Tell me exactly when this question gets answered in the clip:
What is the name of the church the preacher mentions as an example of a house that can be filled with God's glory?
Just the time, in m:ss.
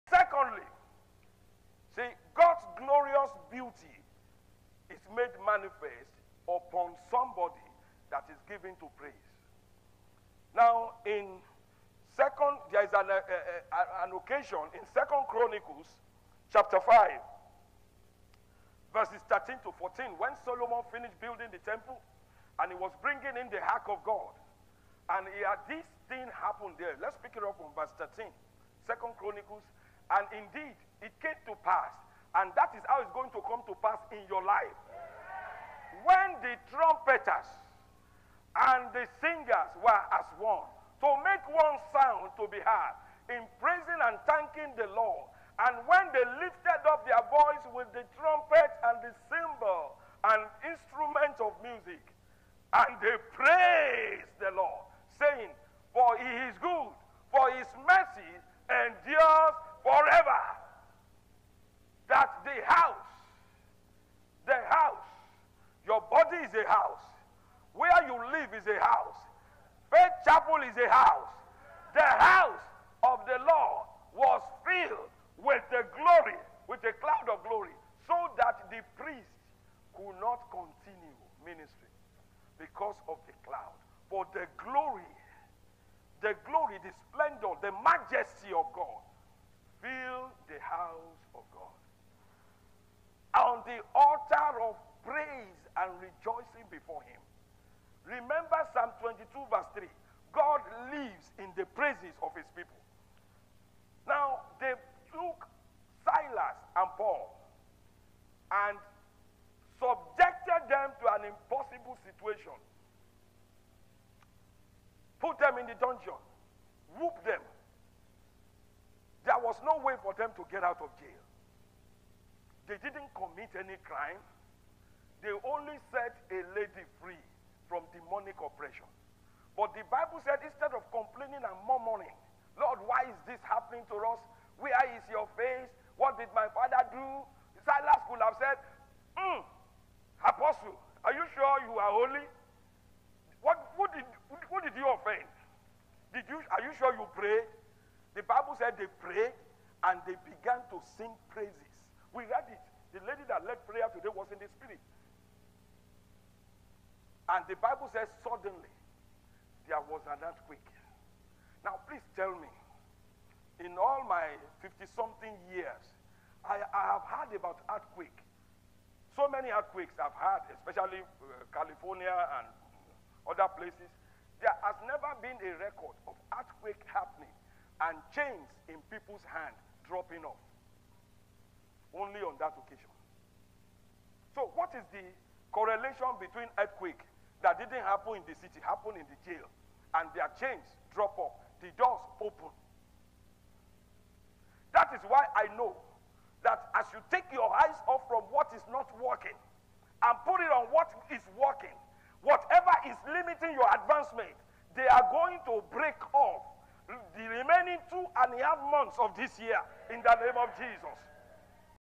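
1:09.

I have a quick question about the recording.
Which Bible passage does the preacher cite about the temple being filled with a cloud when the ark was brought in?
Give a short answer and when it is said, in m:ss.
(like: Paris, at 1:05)
Second Chronicles 5:13-14, at 0:14.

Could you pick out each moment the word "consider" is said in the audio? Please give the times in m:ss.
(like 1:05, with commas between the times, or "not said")
not said.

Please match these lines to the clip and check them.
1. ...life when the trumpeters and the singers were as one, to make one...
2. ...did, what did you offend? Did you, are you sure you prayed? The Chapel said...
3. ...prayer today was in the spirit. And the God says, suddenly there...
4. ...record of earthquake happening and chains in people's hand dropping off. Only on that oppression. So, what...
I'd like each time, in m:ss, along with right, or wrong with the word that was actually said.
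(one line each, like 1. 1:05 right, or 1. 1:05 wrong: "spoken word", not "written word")
1. 0:34 right
2. 2:23 wrong: "Bible", not "Chapel"
3. 2:33 wrong: "Bible", not "God"
4. 2:55 wrong: "occasion", not "oppression".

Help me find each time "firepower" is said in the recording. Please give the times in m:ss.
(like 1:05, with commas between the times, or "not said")
not said.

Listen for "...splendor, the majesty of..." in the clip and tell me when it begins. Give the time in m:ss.
1:27.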